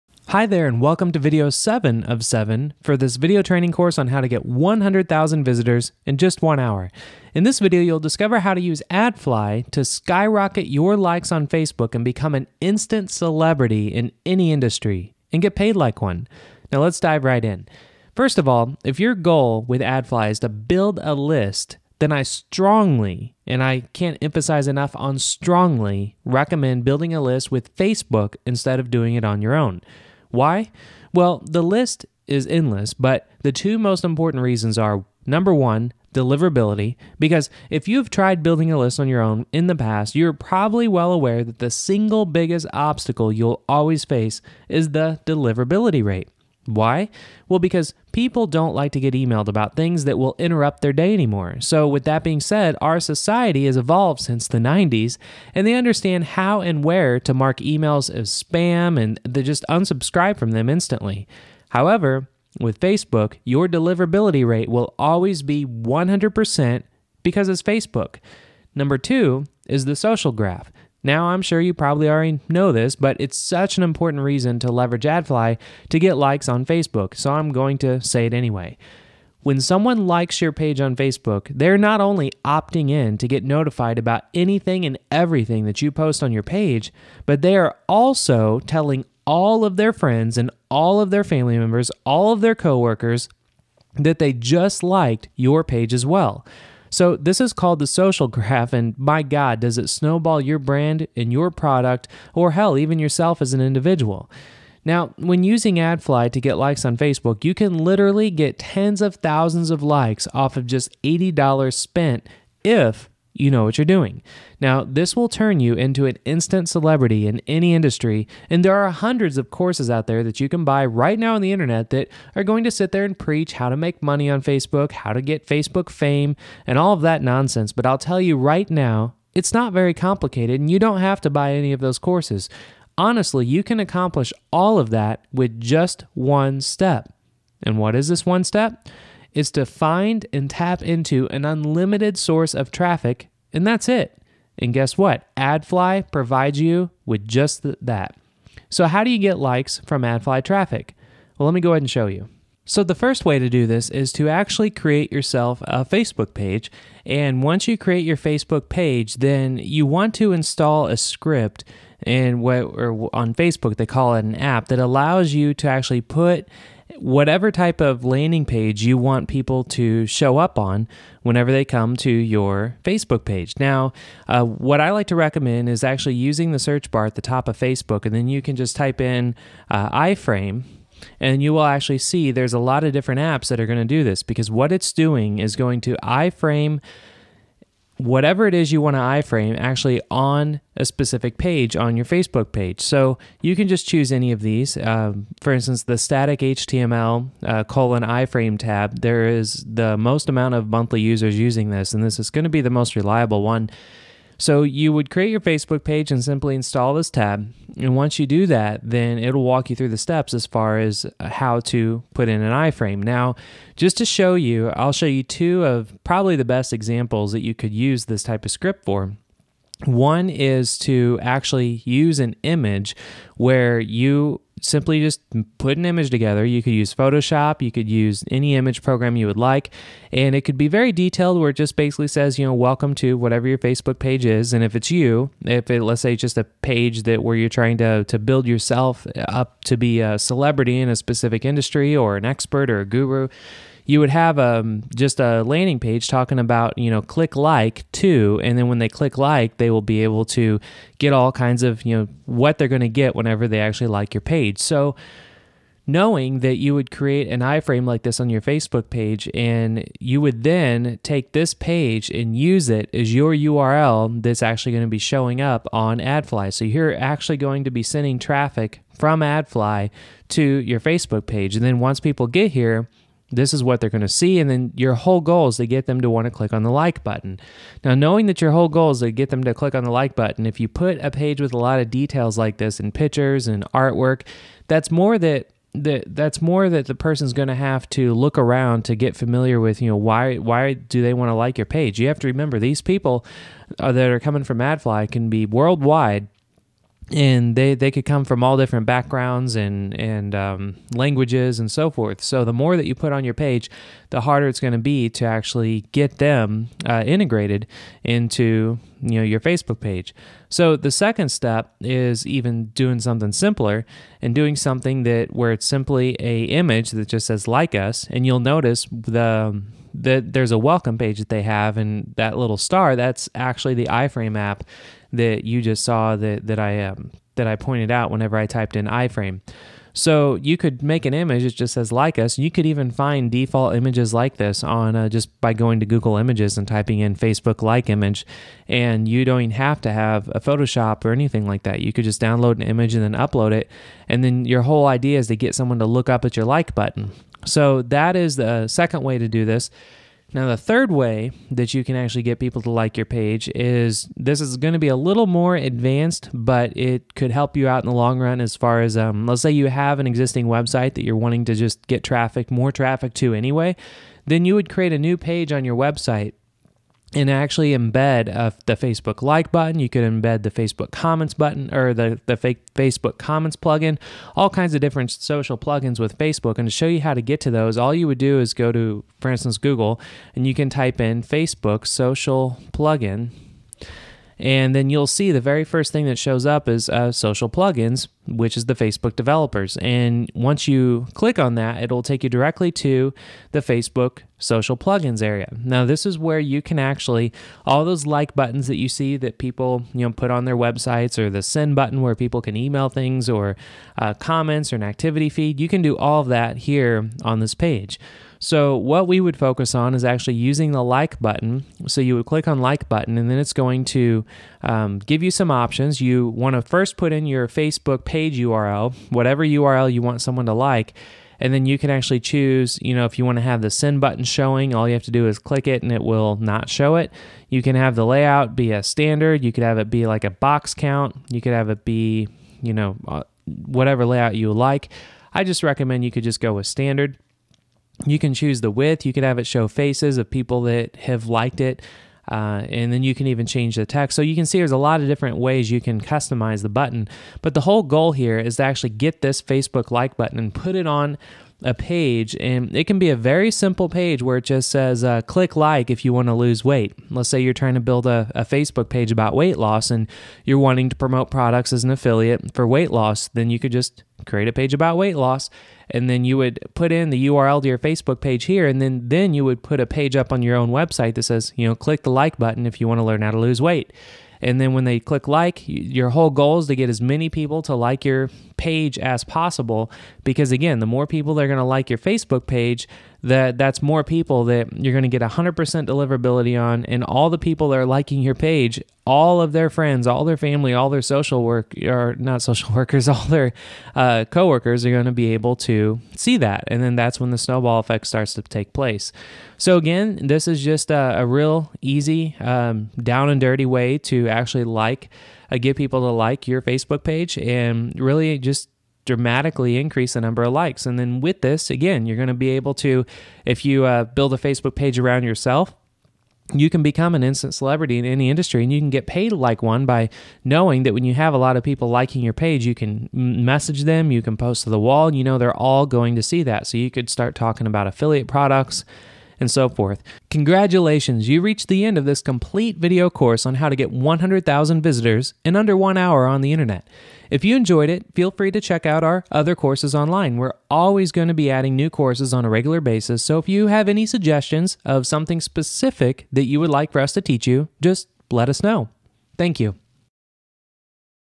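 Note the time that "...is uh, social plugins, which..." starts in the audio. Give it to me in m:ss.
6:26.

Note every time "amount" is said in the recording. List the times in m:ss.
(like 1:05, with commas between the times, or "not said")
3:20.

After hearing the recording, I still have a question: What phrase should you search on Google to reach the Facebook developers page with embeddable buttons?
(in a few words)
Facebook social plugin.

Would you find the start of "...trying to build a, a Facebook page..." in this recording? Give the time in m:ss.
7:37.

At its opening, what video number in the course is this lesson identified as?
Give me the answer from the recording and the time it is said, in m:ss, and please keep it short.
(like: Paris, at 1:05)
7, at 0:01.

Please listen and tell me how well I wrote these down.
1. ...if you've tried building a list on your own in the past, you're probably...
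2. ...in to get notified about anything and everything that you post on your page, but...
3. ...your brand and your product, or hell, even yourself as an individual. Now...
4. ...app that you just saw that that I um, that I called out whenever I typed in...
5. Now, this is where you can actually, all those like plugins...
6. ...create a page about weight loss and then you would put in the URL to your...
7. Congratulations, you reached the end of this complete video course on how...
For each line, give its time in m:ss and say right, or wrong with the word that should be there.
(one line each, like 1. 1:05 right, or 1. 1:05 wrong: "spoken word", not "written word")
1. 0:37 right
2. 1:22 right
3. 1:40 right
4. 5:24 wrong: "pointed", not "called"
5. 6:35 wrong: "buttons", not "plugins"
6. 7:44 right
7. 8:50 right.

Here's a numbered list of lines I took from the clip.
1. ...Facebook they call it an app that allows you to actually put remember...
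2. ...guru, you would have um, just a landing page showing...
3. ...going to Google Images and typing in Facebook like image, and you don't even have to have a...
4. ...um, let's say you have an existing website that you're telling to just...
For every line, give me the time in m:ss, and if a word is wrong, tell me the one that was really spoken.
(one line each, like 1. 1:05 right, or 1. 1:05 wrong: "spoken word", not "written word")
1. 2:43 wrong: "whatever", not "remember"
2. 4:02 wrong: "talking", not "showing"
3. 5:35 right
4. 5:58 wrong: "wanting", not "telling".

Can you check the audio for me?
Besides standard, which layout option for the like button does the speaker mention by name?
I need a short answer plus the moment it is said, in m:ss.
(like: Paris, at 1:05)
box count, at 7:10.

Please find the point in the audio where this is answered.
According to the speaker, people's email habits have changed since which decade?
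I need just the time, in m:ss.
0:54.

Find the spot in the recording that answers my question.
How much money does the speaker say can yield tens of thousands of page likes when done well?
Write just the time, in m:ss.
1:51.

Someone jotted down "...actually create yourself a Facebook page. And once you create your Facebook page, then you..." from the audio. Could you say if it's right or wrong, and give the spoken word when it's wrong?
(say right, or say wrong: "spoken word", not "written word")
right.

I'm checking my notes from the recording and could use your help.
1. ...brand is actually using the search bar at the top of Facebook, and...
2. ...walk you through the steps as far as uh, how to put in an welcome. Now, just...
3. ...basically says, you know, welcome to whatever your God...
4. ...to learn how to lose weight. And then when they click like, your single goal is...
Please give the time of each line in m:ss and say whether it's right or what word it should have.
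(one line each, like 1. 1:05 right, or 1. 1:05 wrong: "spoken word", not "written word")
1. 2:55 wrong: "recommend", not "brand"
2. 3:29 wrong: "iframe", not "welcome"
3. 3:51 wrong: "Facebook", not "God"
4. 7:52 wrong: "whole", not "single".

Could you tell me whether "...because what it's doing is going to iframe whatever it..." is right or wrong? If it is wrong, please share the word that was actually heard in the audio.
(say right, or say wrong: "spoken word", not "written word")
right.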